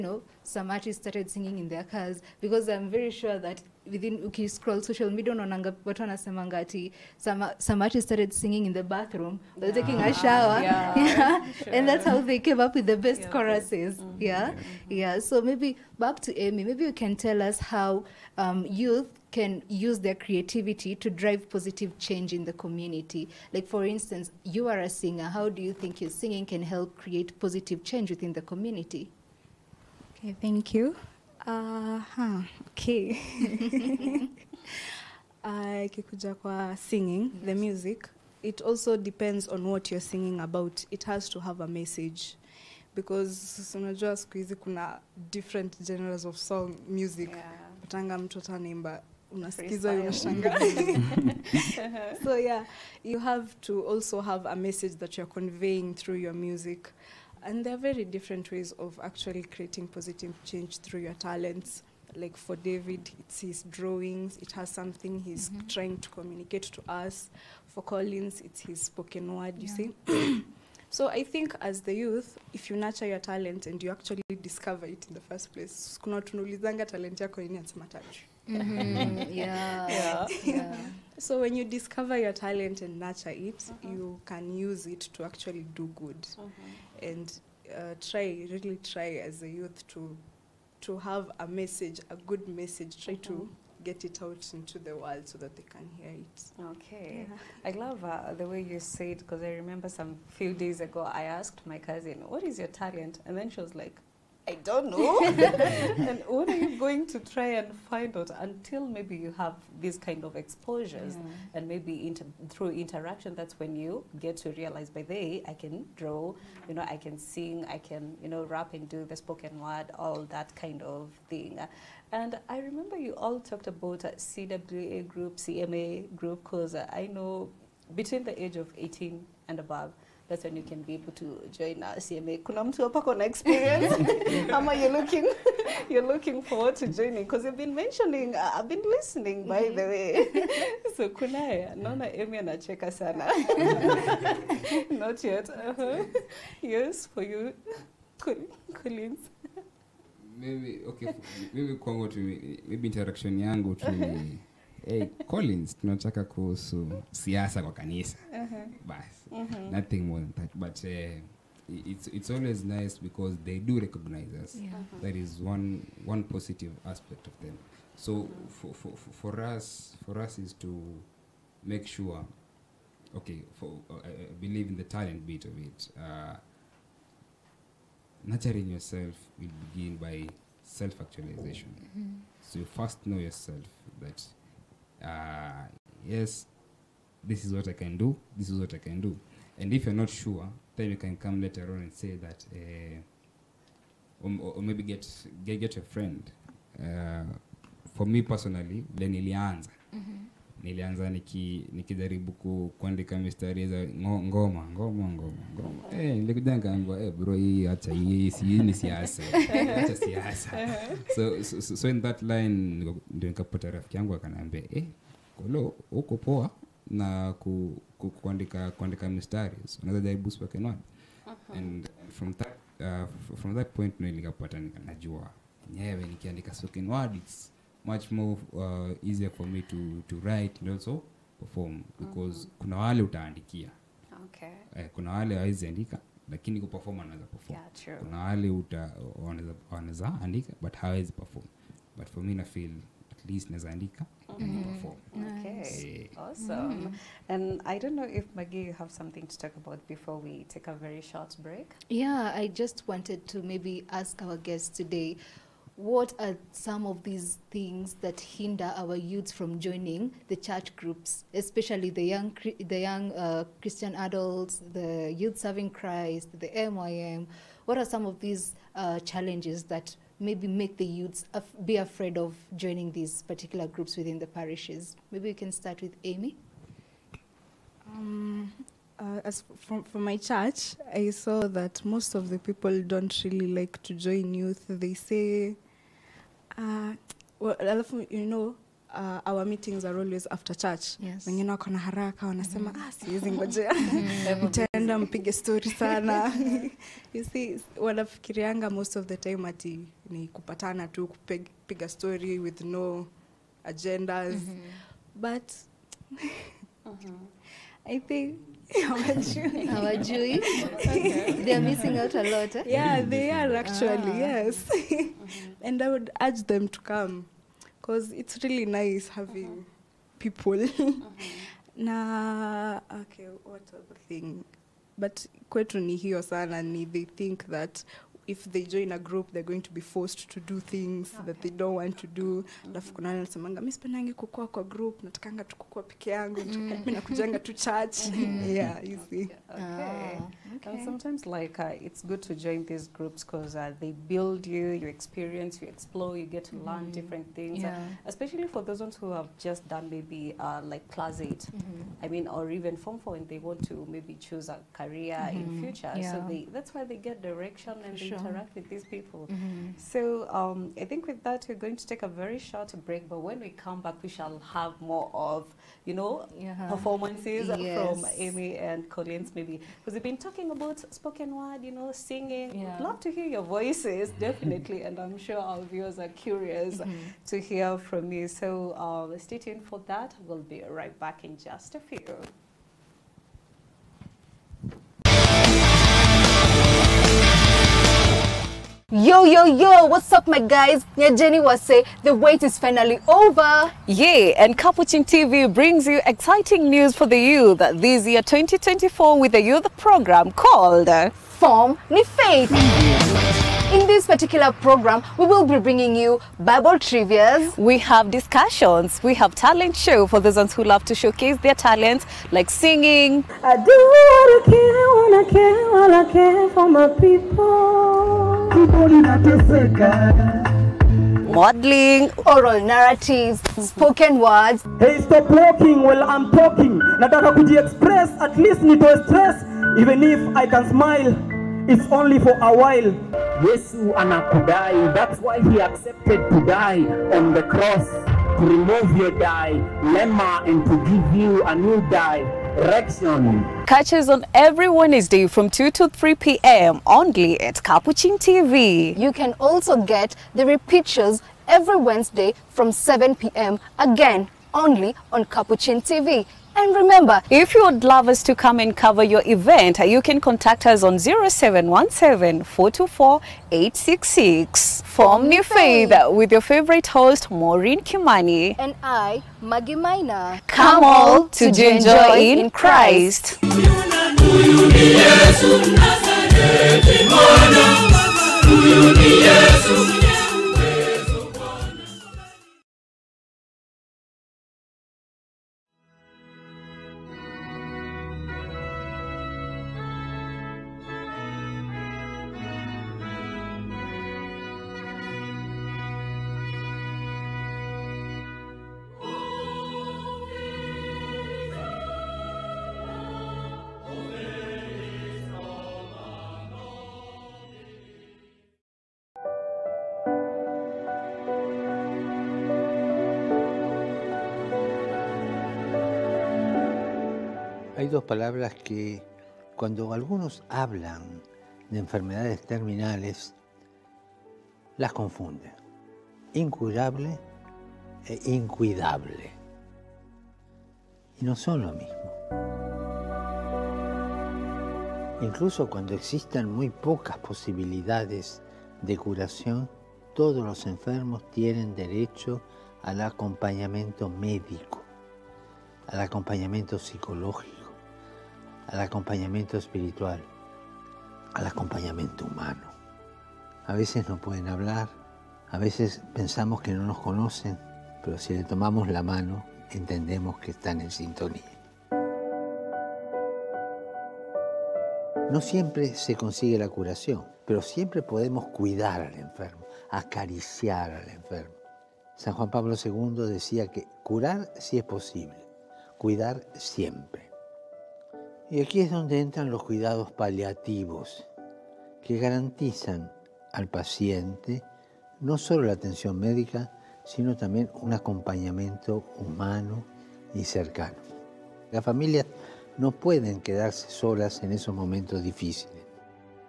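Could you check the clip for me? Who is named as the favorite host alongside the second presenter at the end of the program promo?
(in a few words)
Maureen Kimani.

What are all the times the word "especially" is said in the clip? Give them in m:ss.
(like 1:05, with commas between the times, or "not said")
4:21, 5:48.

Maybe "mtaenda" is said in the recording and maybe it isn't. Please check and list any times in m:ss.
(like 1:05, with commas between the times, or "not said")
4:54.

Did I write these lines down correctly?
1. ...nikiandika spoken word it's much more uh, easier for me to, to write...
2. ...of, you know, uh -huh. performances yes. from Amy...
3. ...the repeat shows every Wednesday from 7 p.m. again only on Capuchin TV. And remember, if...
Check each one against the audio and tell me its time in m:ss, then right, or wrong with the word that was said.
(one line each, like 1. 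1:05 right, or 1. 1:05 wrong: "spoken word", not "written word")
1. 3:46 right
2. 6:05 right
3. 7:30 right.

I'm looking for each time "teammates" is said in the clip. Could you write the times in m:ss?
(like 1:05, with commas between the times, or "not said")
not said.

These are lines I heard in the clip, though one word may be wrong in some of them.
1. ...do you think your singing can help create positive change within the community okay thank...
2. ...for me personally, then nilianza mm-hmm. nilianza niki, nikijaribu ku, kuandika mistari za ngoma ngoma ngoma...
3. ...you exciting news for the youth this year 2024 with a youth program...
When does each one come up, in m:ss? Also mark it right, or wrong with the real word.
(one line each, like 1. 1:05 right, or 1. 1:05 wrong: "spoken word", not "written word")
1. 0:25 right
2. 3:17 right
3. 6:35 right.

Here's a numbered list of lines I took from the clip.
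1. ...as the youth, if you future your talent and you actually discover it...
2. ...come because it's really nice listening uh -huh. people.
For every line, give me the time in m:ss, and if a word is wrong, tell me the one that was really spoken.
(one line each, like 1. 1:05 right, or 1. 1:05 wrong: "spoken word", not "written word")
1. 1:11 wrong: "nurture", not "future"
2. 5:16 wrong: "having", not "listening".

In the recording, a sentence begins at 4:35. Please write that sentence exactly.
Maybe we can start with Amy.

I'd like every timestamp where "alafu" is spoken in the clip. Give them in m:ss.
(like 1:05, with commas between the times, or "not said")
4:47, 5:32.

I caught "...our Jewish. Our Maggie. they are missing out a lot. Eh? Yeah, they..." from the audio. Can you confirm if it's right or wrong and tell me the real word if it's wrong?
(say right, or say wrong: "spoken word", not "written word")
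wrong: "Jewish", not "Maggie".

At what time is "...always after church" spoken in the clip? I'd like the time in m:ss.
4:49.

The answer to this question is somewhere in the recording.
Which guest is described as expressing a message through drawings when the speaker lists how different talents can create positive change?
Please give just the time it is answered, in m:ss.
1:02.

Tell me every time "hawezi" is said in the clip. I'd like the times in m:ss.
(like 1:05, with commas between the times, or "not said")
3:55, 4:00.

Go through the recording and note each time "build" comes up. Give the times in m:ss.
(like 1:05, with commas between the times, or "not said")
5:43.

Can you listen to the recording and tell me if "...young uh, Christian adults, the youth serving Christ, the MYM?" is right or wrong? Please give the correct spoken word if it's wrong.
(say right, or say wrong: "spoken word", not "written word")
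right.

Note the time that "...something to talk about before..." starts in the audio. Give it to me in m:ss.
4:08.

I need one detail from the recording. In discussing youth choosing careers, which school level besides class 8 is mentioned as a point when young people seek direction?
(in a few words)
form 4.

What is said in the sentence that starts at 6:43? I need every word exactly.
In this particular program, we will be bringing you Bible trivias.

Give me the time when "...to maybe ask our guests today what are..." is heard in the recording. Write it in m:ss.
4:13.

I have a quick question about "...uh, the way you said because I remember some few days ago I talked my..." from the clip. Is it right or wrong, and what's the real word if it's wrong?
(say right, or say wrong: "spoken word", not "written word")
wrong: "asked", not "talked".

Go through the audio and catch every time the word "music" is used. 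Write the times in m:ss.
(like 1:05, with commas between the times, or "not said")
0:37, 0:46, 0:56.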